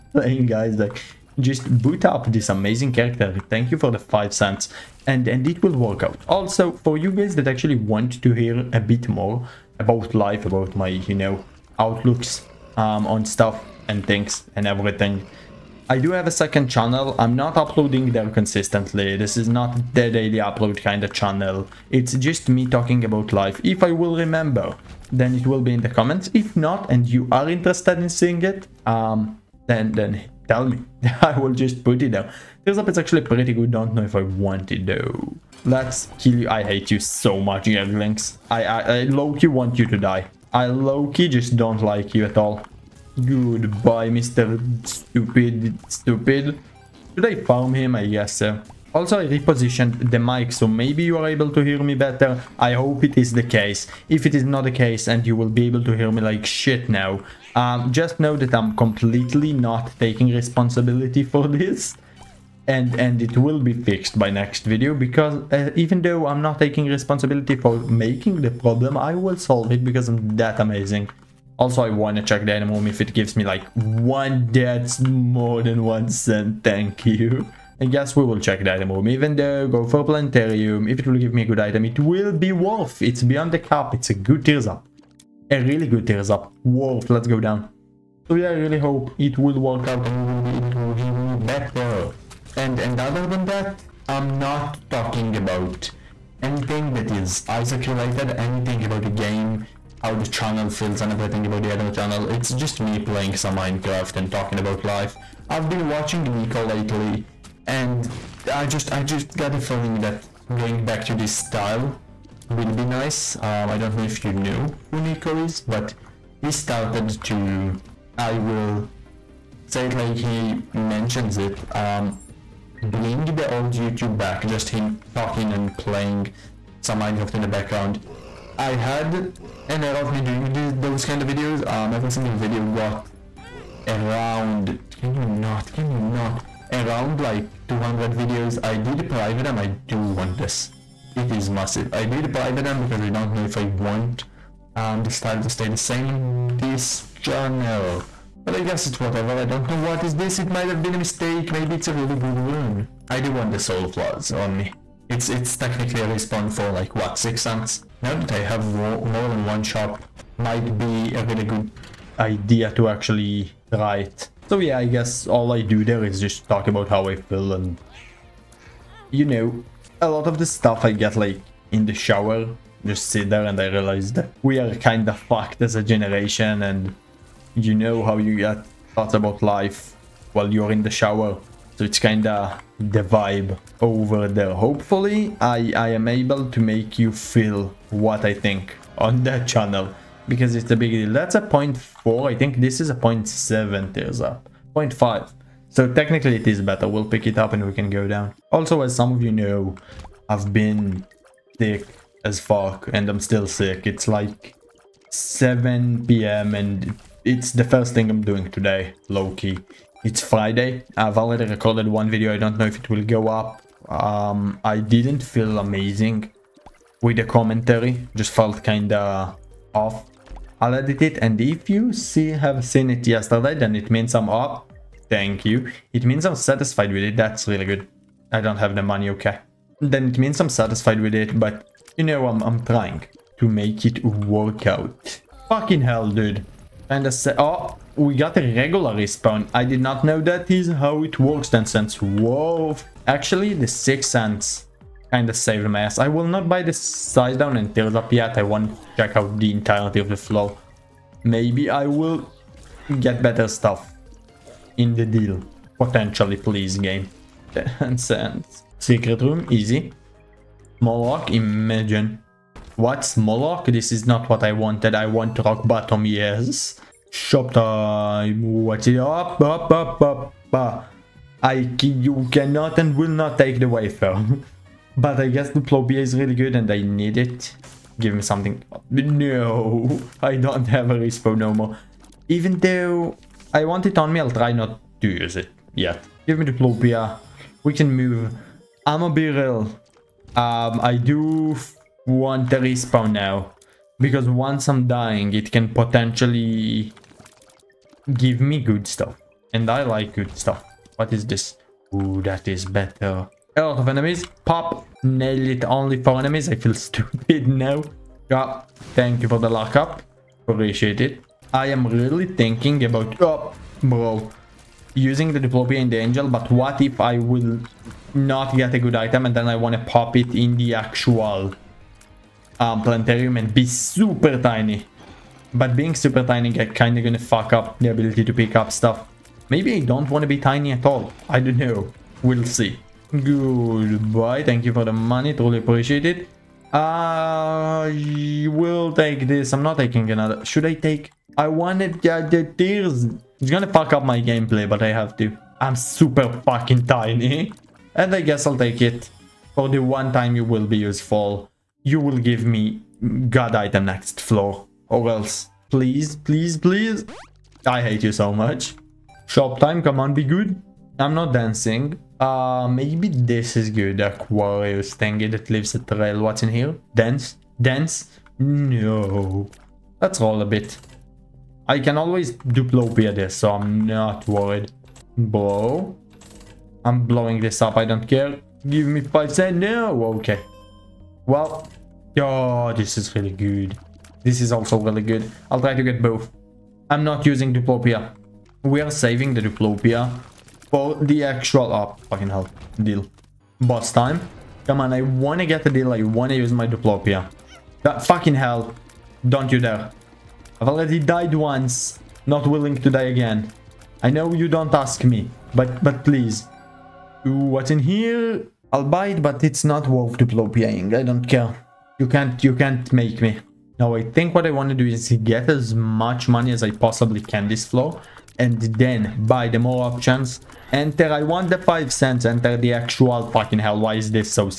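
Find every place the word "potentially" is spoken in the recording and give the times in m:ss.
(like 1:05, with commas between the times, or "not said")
4:15, 4:55.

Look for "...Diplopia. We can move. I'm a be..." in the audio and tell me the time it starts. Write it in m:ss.
4:46.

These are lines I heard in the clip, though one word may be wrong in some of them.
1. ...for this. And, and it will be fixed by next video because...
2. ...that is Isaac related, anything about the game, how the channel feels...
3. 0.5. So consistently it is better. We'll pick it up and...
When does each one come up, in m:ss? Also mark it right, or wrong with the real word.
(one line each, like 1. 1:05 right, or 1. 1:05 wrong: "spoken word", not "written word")
1. 1:01 right
2. 1:36 right
3. 3:14 wrong: "technically", not "consistently".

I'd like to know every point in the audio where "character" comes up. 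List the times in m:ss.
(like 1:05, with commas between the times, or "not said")
0:02.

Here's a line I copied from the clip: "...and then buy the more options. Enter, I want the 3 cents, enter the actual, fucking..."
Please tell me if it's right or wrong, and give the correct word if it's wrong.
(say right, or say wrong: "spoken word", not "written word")
wrong: "5", not "3".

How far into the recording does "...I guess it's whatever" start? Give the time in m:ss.
2:28.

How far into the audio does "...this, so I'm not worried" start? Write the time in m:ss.
6:13.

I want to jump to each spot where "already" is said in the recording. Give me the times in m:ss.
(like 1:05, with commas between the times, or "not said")
3:31, 6:40.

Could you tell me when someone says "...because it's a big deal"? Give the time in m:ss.
3:10.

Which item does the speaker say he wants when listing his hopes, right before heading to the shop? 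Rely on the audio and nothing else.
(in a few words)
Rock Bottom.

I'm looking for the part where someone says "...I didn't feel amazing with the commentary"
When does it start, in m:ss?
3:34.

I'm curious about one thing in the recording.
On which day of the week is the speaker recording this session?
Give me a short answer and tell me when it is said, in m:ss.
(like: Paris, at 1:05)
Friday, at 3:30.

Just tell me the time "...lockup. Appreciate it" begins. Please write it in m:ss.
5:09.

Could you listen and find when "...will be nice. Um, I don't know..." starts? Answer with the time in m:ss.
1:52.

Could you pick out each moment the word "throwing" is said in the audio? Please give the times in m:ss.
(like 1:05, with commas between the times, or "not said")
not said.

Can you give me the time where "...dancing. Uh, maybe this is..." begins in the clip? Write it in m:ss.
6:01.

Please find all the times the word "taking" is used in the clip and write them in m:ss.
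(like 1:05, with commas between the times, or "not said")
0:59, 1:06, 5:39.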